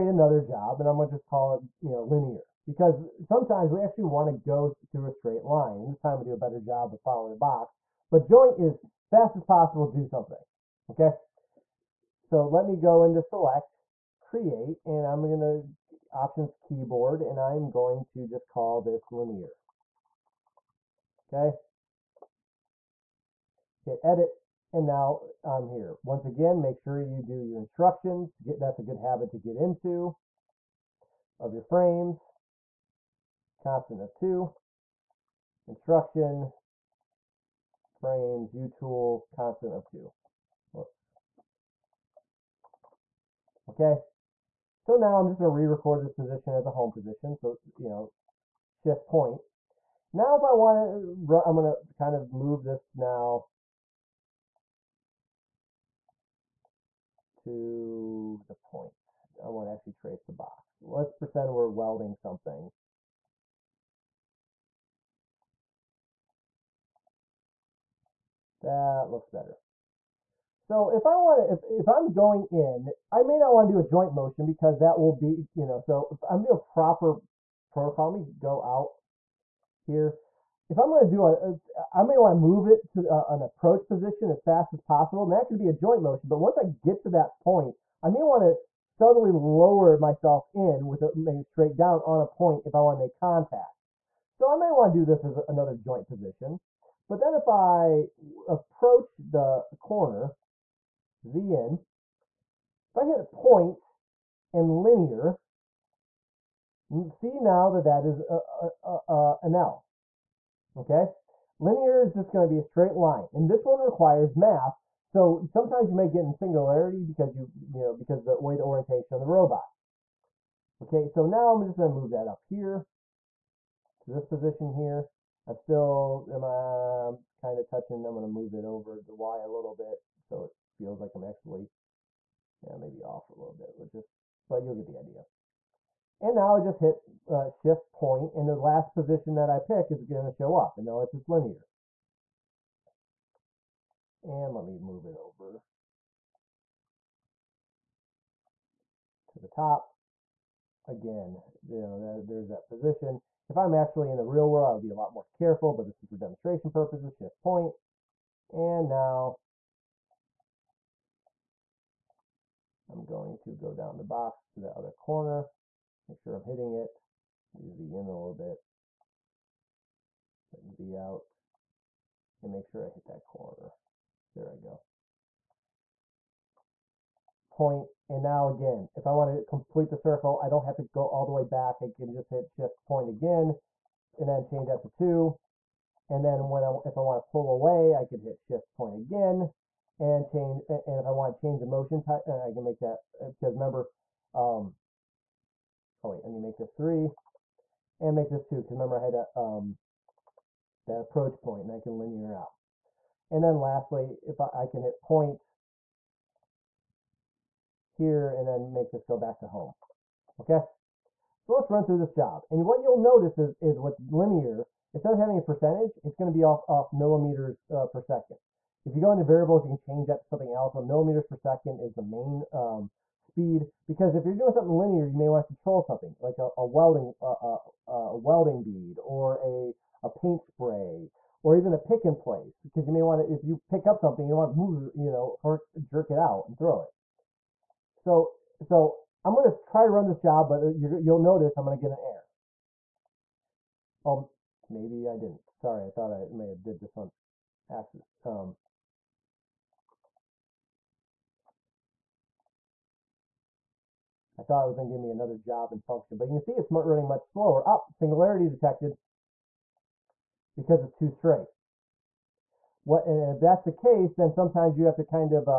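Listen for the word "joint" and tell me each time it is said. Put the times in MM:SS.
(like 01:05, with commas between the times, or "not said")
00:08, 01:13, 01:25, 01:35.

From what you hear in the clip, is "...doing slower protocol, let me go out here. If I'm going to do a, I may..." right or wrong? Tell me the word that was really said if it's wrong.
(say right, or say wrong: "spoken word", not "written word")
wrong: "proper", not "slower".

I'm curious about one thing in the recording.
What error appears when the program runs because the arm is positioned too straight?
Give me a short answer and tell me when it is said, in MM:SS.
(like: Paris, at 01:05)
singularity detected, at 04:17.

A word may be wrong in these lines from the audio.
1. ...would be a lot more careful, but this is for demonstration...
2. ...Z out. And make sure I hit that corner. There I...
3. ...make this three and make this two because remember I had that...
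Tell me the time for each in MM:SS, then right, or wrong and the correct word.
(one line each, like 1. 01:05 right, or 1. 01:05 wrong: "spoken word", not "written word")
1. 02:34 right
2. 02:50 right
3. 03:16 right.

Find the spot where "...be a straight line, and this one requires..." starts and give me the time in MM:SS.
01:52.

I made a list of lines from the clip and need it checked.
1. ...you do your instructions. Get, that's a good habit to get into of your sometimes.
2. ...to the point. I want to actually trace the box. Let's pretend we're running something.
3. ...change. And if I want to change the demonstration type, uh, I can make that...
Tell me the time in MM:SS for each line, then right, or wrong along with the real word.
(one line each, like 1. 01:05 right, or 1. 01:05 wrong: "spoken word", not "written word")
1. 00:27 wrong: "frames", not "sometimes"
2. 00:57 wrong: "welding", not "running"
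3. 03:10 wrong: "motion", not "demonstration".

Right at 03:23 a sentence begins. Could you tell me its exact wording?
And then lastly, if I, I can hit point here and then make this go back to home.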